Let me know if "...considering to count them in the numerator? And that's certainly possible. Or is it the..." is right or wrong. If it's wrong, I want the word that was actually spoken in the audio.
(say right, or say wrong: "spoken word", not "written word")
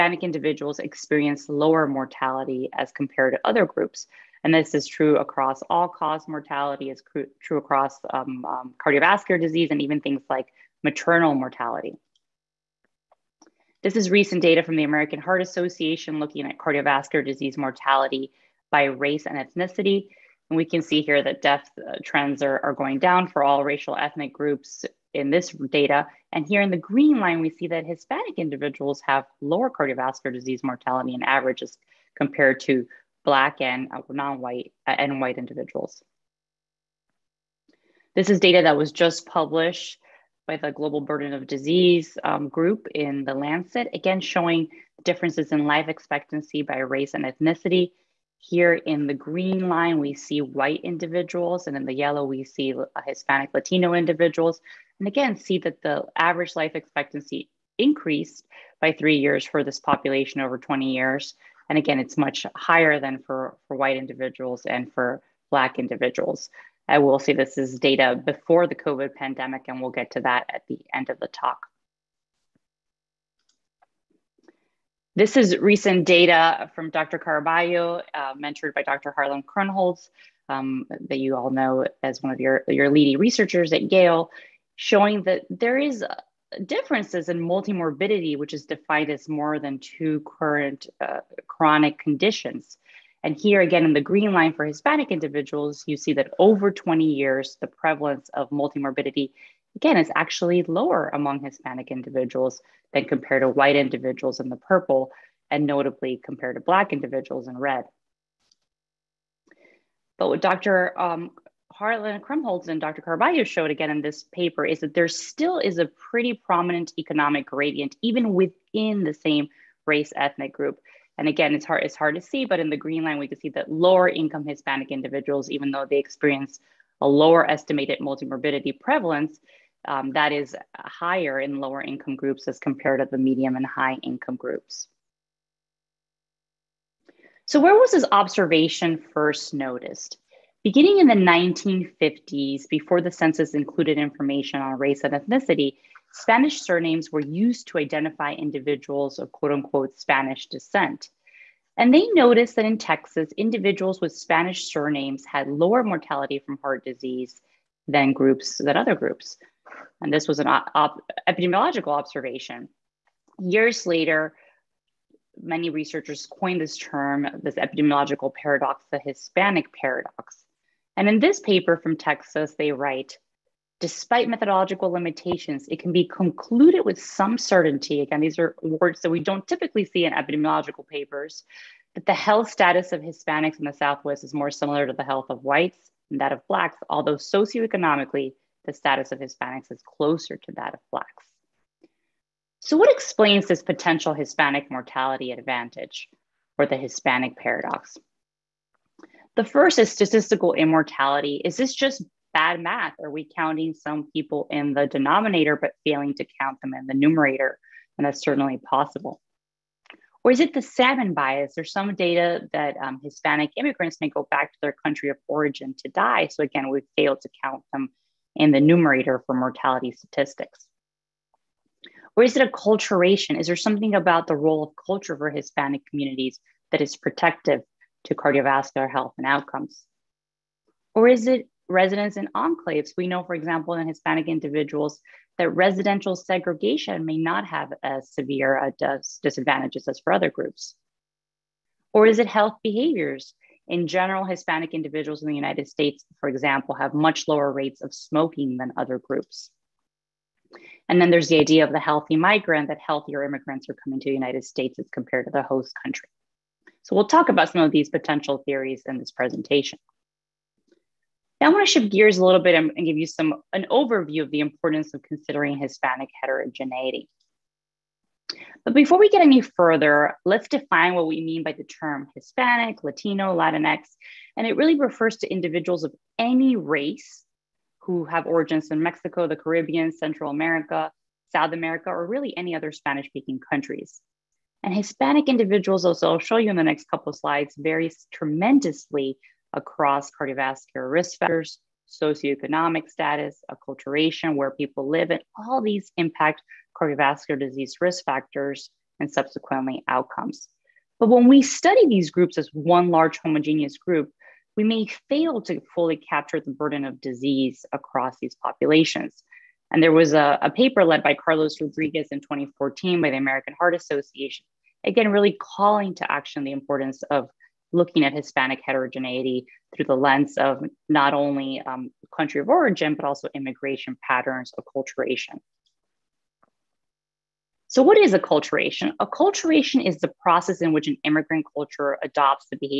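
wrong: "failing", not "considering".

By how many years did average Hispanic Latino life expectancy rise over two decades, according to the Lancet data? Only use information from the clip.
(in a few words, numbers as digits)
3.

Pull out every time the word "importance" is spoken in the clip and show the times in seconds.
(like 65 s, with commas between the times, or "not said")
264 s, 316 s.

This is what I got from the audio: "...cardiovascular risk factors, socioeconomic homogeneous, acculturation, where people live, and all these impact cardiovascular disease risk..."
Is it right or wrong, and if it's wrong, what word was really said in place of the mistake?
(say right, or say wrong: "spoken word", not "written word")
wrong: "status", not "homogeneous".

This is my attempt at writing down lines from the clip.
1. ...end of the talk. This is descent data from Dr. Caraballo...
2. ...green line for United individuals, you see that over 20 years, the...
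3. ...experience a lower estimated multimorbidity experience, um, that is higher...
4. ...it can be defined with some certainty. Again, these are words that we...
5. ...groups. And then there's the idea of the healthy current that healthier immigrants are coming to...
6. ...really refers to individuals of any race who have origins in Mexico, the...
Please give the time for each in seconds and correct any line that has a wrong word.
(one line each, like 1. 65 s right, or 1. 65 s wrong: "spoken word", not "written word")
1. 70 s wrong: "recent", not "descent"
2. 94 s wrong: "Hispanic", not "United"
3. 125 s wrong: "prevalence", not "experience"
4. 175 s wrong: "concluded", not "defined"
5. 248 s wrong: "migrant", not "current"
6. 274 s right.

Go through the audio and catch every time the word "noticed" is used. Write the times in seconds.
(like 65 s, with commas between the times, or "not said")
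139 s, 152 s.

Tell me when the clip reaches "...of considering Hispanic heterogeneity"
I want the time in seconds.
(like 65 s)
264 s.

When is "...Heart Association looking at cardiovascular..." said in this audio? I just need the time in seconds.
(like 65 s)
15 s.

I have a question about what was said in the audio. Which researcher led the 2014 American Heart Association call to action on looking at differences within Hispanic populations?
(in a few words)
Carlos Rodriguez.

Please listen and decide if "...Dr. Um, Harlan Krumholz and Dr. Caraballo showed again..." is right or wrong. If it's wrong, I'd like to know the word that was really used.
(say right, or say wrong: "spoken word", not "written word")
right.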